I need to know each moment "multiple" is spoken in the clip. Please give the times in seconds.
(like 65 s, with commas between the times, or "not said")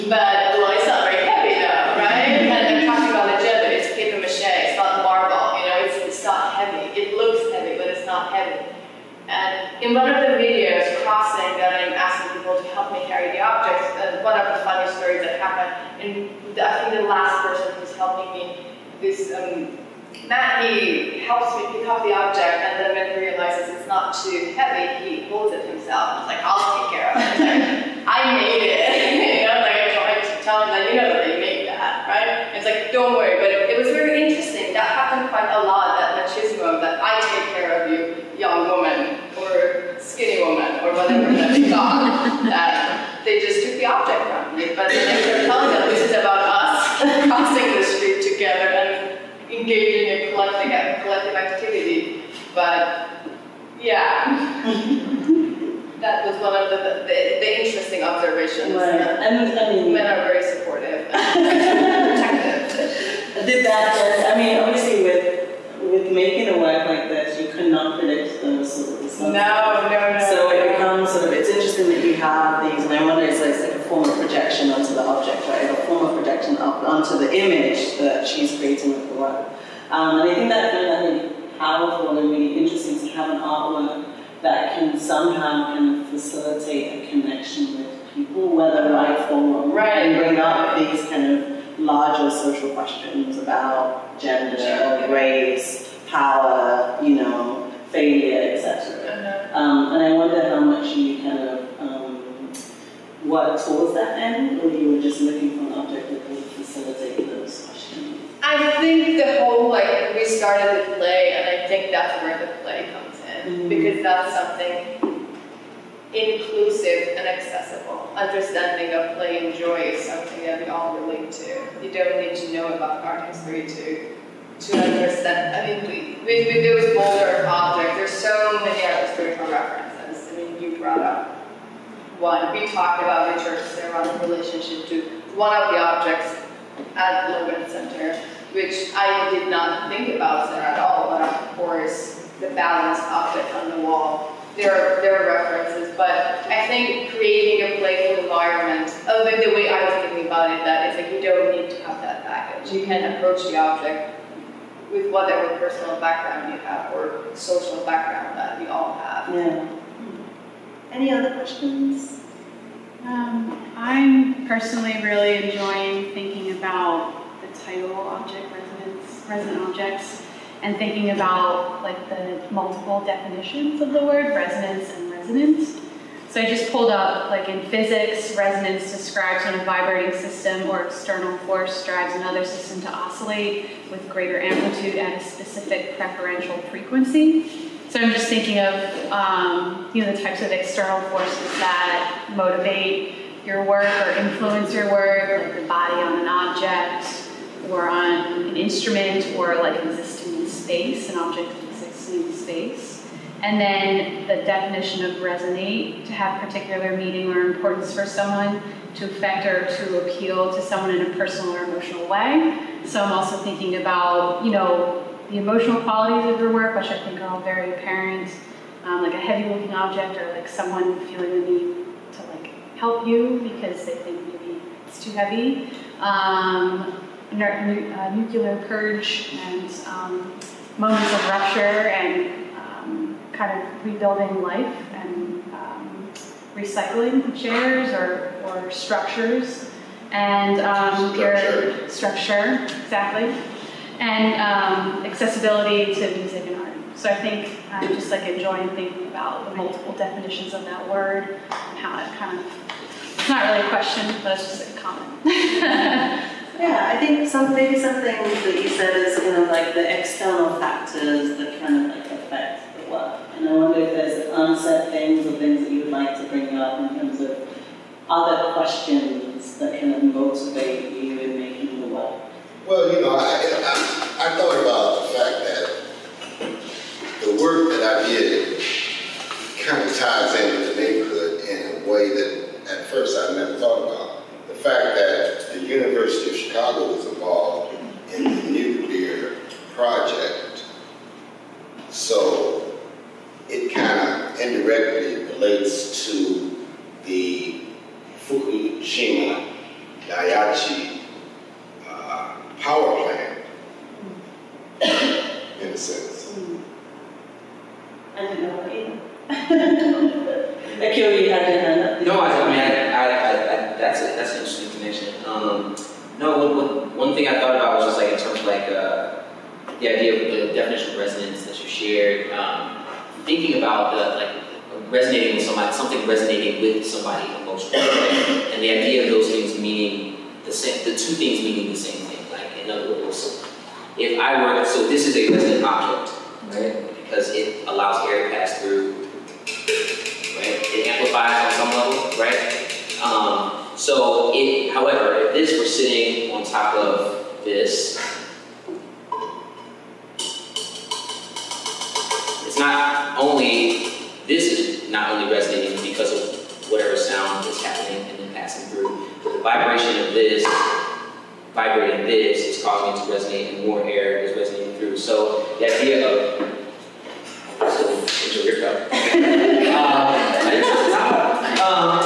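172 s, 249 s.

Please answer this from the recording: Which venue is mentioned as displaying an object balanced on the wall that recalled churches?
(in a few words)
Logan Center.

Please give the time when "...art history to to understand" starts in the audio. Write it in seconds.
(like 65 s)
123 s.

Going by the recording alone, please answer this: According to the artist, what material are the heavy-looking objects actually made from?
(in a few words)
paper mache.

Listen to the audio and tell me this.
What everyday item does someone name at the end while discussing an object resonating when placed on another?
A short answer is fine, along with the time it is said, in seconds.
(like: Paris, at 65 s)
cup, at 368 s.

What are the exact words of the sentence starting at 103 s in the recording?
what that end, or you were just looking for an object that would facilitate those questions?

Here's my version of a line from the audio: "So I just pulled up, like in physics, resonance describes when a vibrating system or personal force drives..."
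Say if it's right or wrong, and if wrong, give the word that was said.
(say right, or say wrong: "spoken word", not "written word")
wrong: "external", not "personal".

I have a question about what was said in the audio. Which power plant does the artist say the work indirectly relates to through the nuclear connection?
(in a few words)
Fukushima Daiichi.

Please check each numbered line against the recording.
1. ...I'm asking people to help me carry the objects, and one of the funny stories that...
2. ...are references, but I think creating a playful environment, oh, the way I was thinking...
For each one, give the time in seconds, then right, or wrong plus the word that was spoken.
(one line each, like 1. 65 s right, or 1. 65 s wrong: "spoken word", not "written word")
1. 11 s right
2. 145 s right.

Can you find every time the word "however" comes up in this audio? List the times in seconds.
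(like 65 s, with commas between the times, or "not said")
344 s.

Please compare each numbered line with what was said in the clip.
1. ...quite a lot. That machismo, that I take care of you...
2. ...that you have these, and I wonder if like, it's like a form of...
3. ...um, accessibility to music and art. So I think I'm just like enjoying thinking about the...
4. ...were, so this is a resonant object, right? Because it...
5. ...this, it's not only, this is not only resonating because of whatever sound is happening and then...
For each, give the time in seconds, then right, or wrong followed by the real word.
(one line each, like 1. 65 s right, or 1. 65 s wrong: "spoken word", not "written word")
1. 35 s right
2. 71 s right
3. 244 s right
4. 334 s right
5. 347 s right.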